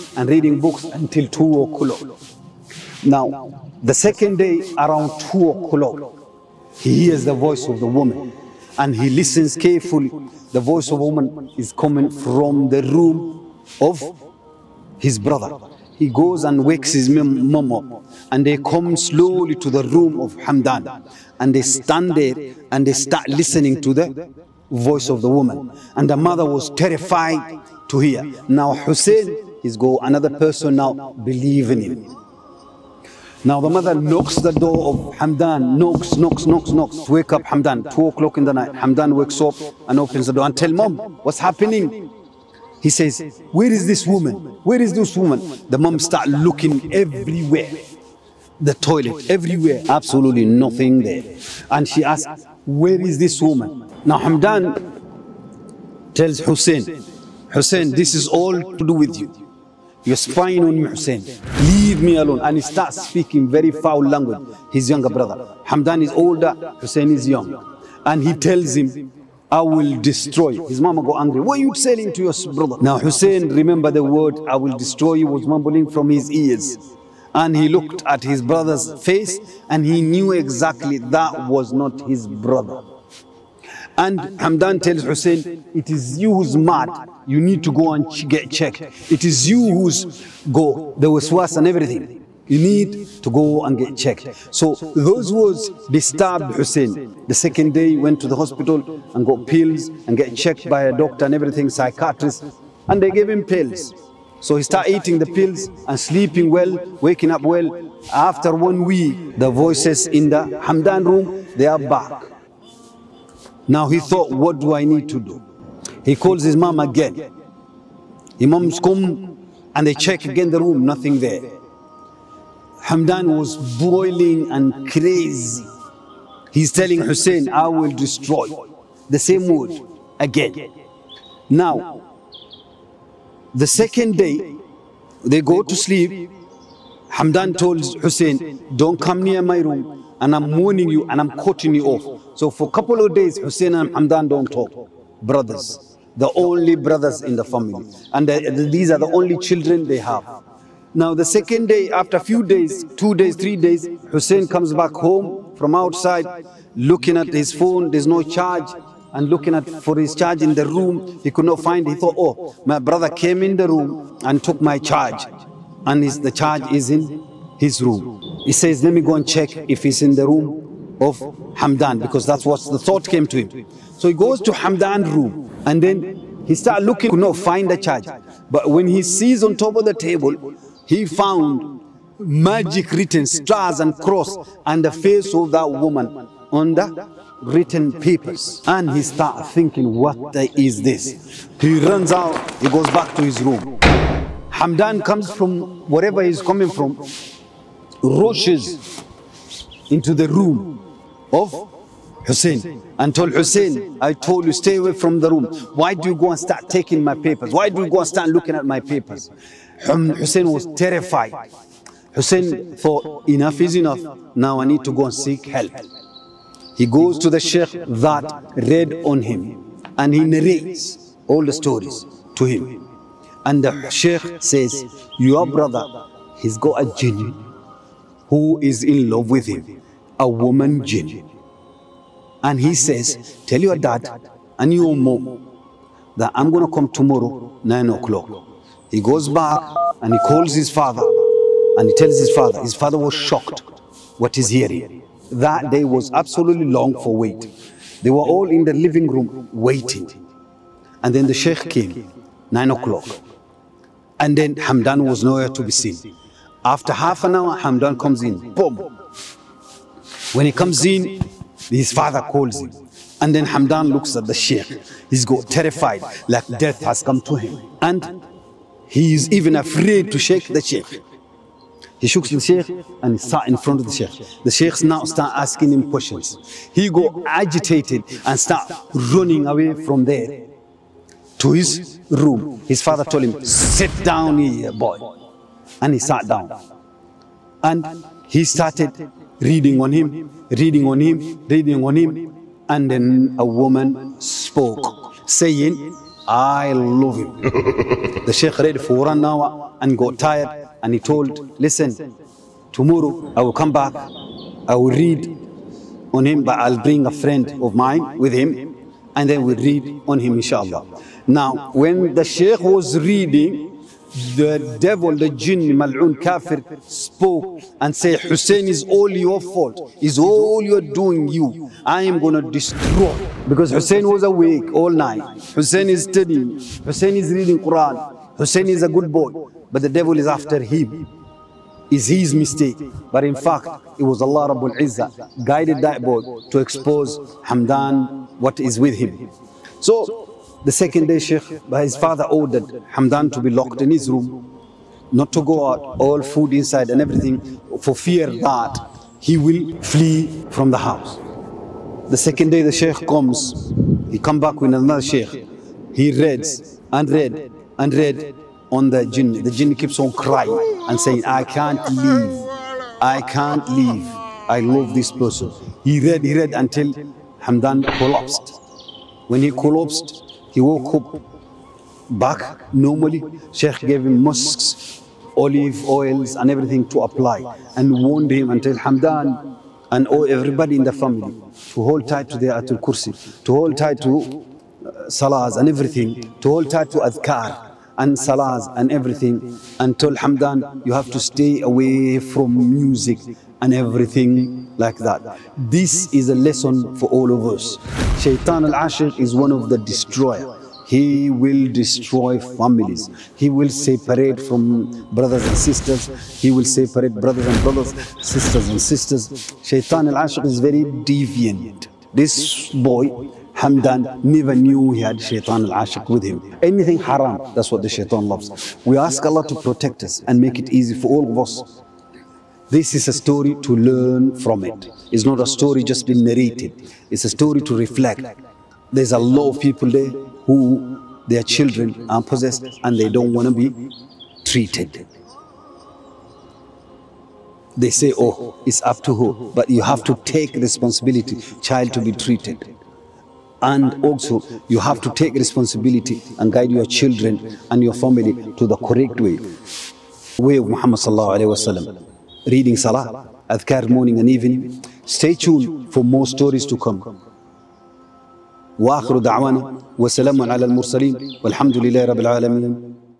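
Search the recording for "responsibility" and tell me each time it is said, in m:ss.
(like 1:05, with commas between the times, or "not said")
7:20, 7:25.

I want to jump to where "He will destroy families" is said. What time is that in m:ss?
6:40.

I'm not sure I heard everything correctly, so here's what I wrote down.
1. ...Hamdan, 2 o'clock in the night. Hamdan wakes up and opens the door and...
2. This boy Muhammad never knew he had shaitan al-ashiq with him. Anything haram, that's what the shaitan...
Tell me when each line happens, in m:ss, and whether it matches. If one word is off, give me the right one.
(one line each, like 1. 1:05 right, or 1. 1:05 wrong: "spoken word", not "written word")
1. 0:37 right
2. 6:52 wrong: "Hamdan", not "Muhammad".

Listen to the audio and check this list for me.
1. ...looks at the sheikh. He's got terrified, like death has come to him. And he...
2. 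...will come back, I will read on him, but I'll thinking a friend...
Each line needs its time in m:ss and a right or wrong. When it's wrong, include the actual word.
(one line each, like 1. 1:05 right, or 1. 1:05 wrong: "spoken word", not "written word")
1. 4:23 right
2. 5:03 wrong: "bring", not "thinking".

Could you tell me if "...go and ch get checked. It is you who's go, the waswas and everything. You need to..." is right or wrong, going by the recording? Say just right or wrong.
right.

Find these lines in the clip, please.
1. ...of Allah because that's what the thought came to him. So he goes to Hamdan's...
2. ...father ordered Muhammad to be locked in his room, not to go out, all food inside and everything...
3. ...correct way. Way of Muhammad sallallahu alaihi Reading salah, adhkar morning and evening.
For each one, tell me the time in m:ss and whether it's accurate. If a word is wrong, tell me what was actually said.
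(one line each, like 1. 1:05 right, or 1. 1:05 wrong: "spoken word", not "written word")
1. 2:51 wrong: "Hamdan", not "Allah"
2. 5:41 wrong: "Hamdan", not "Muhammad"
3. 7:28 right.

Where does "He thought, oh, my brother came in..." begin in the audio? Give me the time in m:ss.
2:41.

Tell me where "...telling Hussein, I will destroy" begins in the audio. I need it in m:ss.
2:06.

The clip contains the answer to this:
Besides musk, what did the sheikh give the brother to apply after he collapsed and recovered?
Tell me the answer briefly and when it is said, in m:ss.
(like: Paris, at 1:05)
olive oils, at 6:15.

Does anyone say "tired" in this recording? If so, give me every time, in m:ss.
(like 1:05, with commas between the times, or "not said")
5:00.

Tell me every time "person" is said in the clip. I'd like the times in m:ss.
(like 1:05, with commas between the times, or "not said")
0:30, 6:05.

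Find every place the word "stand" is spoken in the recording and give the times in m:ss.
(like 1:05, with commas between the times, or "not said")
0:21.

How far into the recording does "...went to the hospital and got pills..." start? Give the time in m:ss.
1:37.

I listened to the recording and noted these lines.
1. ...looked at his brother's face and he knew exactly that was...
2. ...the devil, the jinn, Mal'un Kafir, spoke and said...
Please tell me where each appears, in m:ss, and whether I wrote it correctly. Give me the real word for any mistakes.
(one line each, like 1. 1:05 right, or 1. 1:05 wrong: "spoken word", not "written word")
1. 1:17 right
2. 5:14 right.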